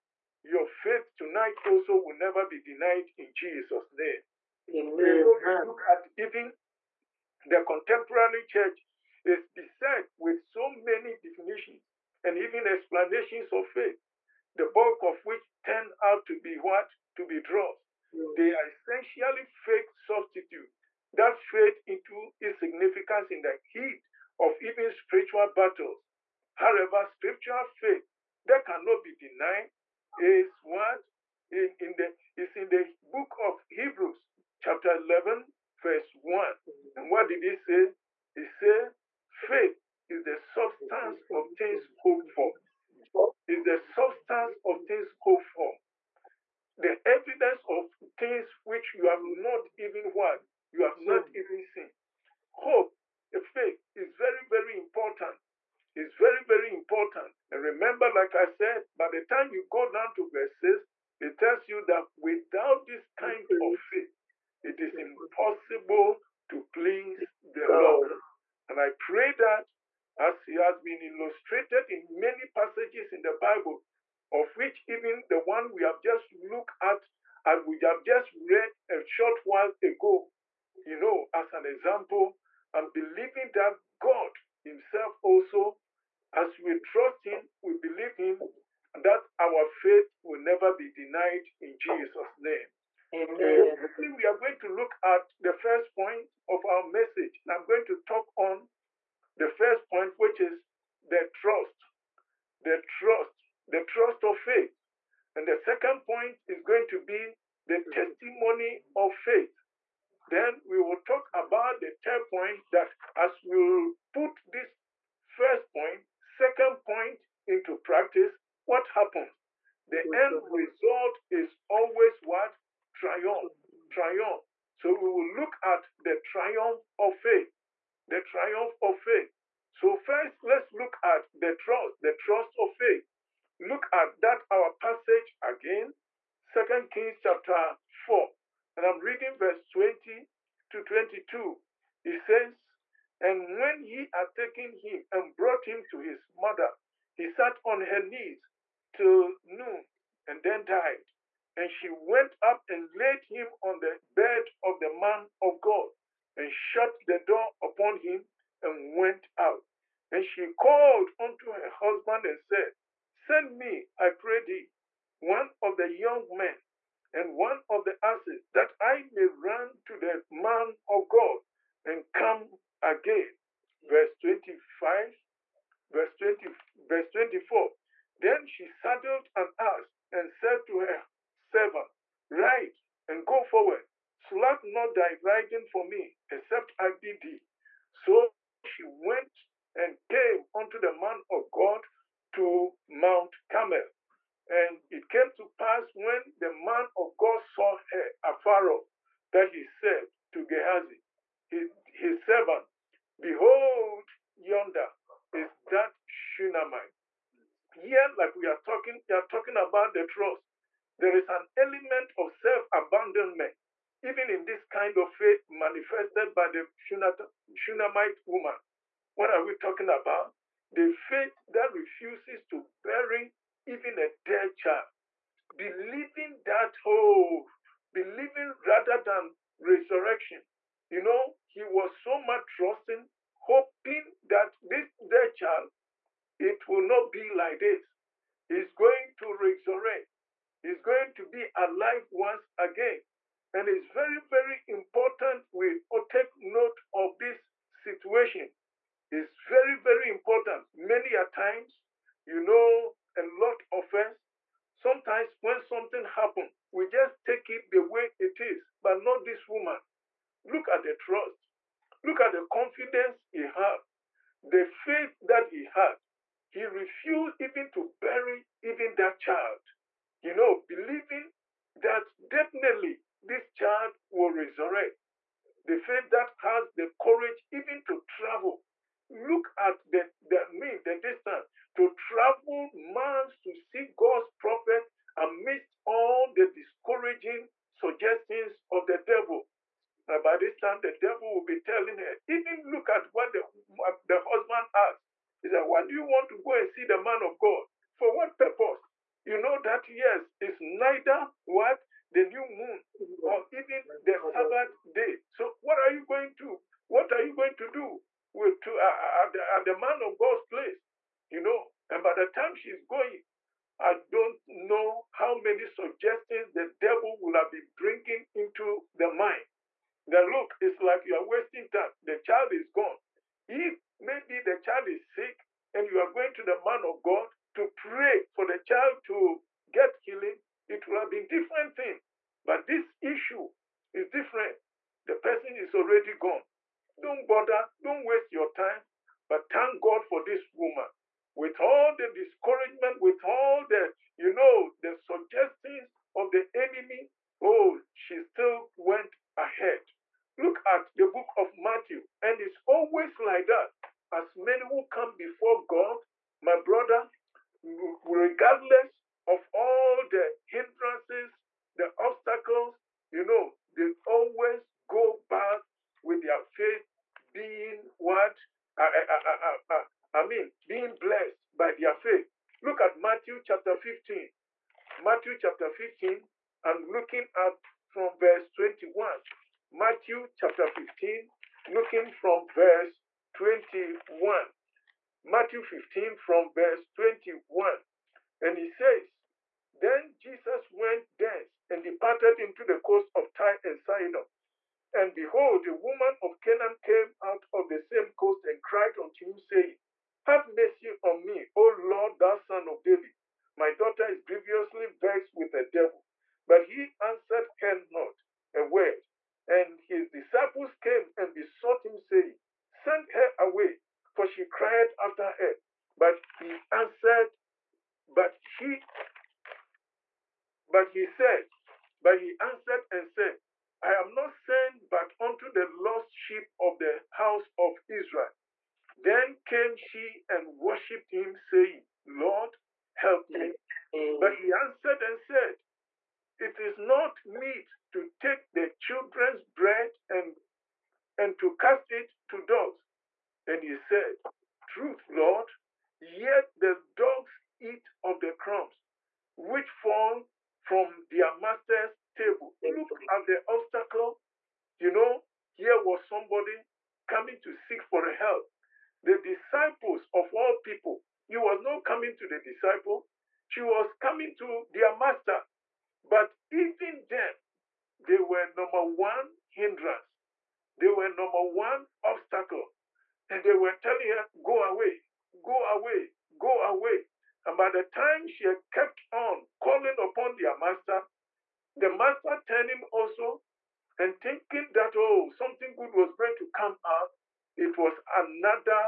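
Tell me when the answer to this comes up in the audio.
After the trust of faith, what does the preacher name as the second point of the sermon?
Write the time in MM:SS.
01:47.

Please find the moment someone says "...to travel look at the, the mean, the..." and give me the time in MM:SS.
04:37.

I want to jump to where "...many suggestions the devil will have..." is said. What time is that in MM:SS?
05:15.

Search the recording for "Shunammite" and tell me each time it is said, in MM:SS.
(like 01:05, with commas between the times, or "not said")
03:26, 03:37.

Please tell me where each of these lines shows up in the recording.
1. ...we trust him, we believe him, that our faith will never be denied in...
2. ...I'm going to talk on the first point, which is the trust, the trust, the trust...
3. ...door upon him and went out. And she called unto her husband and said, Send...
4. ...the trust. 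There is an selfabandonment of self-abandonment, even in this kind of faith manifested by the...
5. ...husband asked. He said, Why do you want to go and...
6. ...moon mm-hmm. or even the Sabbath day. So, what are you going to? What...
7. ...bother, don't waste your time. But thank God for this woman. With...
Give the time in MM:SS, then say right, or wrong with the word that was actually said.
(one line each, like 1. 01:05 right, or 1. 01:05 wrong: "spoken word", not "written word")
1. 01:26 right
2. 01:37 right
3. 02:37 right
4. 03:29 wrong: "element", not "selfabandonment"
5. 04:54 right
6. 05:02 right
7. 05:37 right.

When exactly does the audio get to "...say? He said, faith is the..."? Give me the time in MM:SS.
00:37.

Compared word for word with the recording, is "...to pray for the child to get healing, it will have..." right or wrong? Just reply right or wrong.
right.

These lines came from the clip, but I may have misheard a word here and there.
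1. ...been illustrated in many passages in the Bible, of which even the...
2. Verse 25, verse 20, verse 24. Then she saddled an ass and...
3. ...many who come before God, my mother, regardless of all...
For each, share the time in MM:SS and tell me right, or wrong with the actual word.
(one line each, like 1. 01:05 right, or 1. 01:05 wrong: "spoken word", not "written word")
1. 01:10 right
2. 02:53 right
3. 05:54 wrong: "brother", not "mother".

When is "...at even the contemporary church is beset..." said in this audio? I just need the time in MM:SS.
00:05.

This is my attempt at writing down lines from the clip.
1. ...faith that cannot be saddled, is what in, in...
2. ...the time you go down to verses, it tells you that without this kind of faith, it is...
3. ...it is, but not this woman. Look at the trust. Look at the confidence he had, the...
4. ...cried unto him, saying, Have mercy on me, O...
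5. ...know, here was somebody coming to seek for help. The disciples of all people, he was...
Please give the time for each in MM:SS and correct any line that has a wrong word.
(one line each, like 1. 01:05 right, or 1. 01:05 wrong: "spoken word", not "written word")
1. 00:27 wrong: "denied", not "saddled"
2. 00:59 right
3. 04:18 right
4. 06:38 right
5. 07:34 right.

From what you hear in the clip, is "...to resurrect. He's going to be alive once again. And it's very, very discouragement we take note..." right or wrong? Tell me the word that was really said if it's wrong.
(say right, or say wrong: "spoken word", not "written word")
wrong: "important", not "discouragement".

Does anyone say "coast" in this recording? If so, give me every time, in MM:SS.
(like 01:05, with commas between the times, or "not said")
06:32, 06:38.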